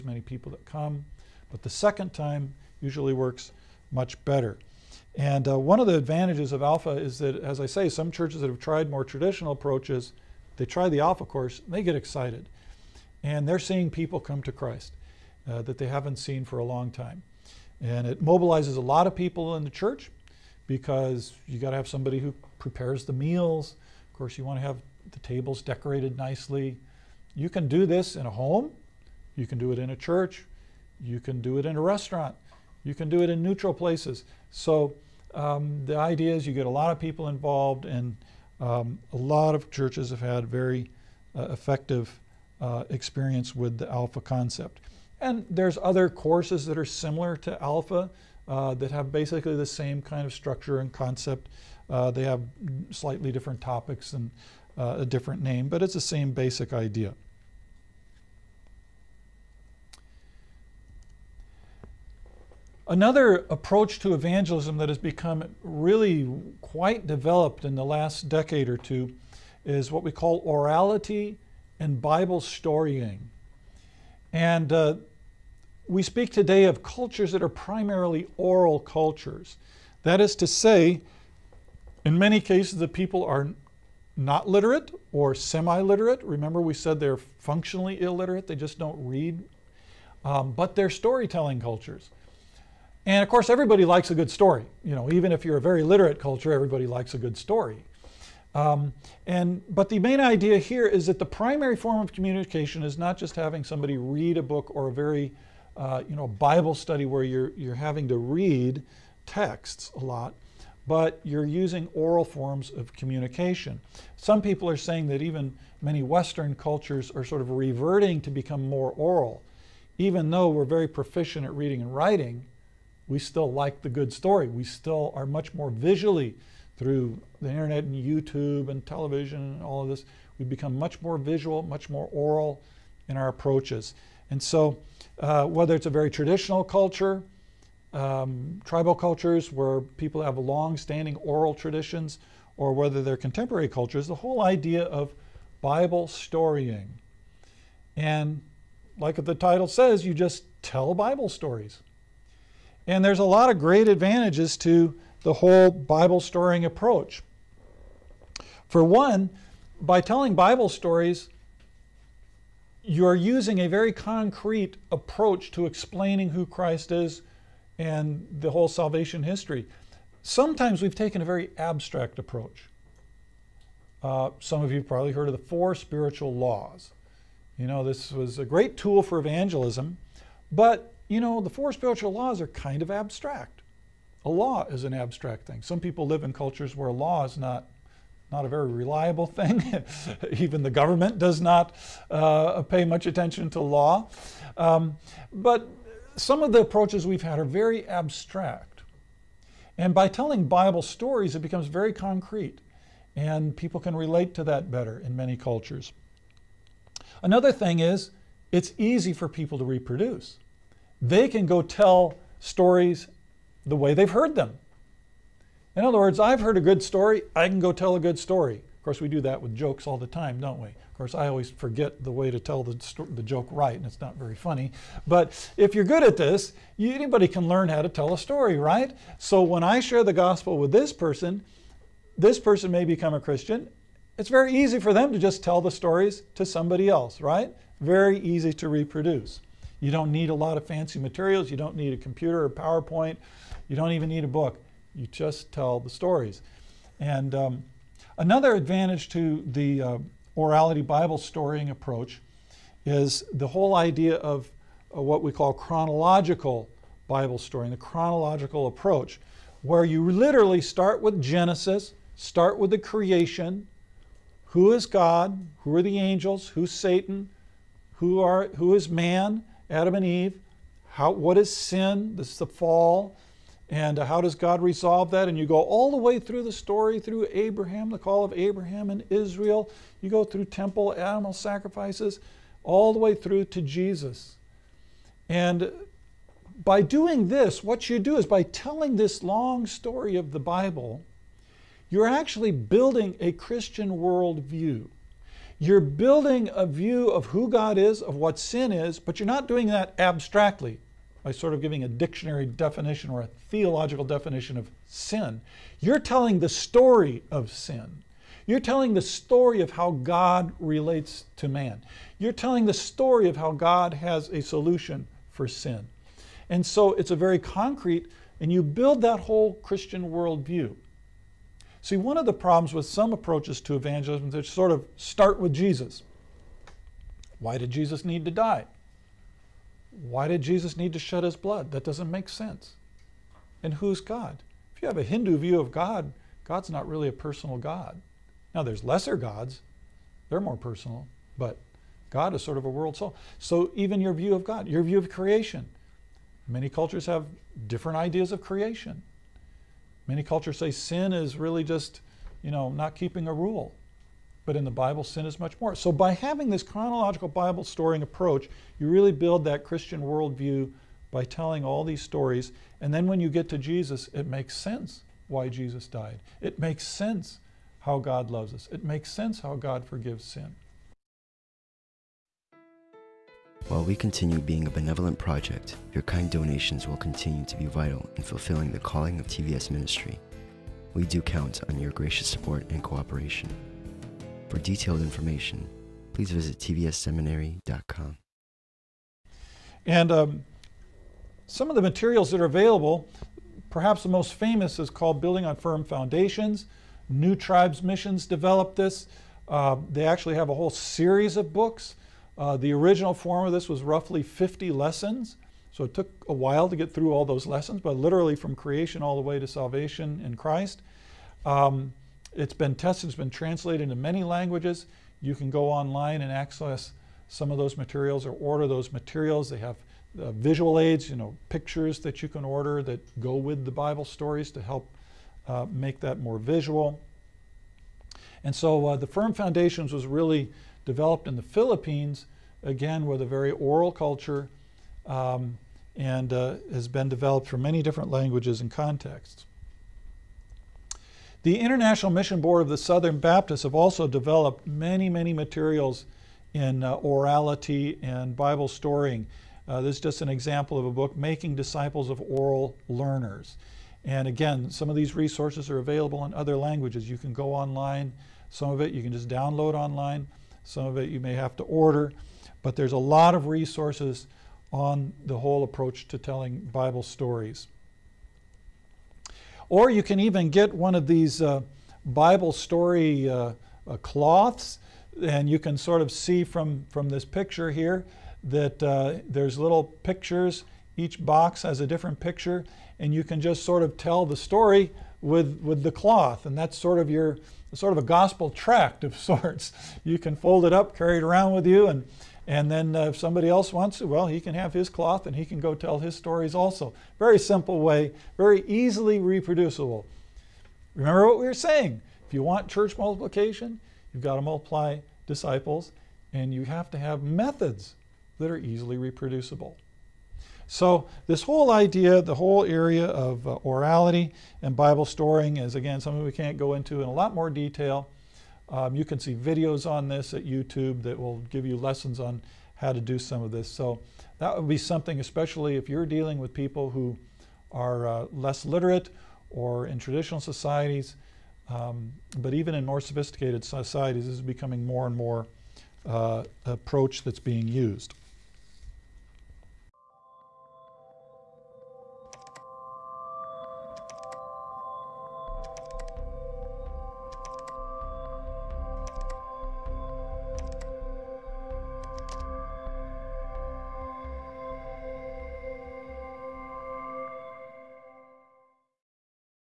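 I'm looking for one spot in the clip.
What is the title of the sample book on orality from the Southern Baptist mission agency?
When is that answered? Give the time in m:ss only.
7:31.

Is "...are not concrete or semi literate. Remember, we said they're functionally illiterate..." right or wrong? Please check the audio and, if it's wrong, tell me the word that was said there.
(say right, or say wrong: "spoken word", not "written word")
wrong: "literate", not "concrete".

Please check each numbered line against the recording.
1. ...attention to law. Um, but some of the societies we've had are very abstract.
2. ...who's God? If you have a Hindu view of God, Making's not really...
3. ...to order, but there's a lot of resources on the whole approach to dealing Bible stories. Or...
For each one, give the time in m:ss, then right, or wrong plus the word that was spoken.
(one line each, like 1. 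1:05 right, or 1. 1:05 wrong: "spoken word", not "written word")
1. 3:13 wrong: "approaches", not "societies"
2. 5:33 wrong: "God", not "Making"
3. 7:41 wrong: "telling", not "dealing".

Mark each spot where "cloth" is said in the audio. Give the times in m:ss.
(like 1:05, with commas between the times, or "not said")
7:53, 8:05, 8:14.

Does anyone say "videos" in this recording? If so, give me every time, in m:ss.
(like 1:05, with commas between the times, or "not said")
8:39.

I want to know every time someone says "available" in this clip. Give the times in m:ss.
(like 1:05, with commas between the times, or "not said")
6:32, 7:35.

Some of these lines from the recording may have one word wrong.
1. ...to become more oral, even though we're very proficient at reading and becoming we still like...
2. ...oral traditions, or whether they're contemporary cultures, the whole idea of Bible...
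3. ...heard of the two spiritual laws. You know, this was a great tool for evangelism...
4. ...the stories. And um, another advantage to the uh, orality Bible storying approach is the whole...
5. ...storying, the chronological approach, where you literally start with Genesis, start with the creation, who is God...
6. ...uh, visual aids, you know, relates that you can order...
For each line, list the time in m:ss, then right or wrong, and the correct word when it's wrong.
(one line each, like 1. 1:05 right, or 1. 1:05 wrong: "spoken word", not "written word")
1. 1:58 wrong: "writing", not "becoming"
2. 2:21 right
3. 2:55 wrong: "four", not "two"
4. 4:05 right
5. 4:17 right
6. 7:00 wrong: "pictures", not "relates".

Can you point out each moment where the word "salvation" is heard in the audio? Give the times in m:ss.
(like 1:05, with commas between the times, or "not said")
2:48, 6:49.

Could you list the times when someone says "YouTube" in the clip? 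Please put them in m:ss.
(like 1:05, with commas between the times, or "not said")
2:07, 8:40.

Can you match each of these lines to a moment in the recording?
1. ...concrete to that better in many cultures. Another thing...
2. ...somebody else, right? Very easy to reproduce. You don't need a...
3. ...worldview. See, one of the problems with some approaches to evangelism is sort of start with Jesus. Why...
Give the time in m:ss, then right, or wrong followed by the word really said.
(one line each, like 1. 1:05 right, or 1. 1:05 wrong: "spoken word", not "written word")
1. 3:23 wrong: "relate", not "concrete"
2. 3:56 right
3. 5:20 right.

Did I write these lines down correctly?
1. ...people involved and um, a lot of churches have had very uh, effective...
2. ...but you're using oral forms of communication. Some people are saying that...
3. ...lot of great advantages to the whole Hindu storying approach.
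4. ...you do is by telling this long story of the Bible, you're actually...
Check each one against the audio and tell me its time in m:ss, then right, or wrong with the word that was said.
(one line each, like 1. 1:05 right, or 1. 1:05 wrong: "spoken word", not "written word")
1. 0:36 right
2. 1:50 right
3. 2:33 wrong: "Bible", not "Hindu"
4. 4:47 right.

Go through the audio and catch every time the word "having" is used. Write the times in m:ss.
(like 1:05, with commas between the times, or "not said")
1:43, 1:47, 5:56.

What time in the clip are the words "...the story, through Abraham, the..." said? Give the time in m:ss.
4:36.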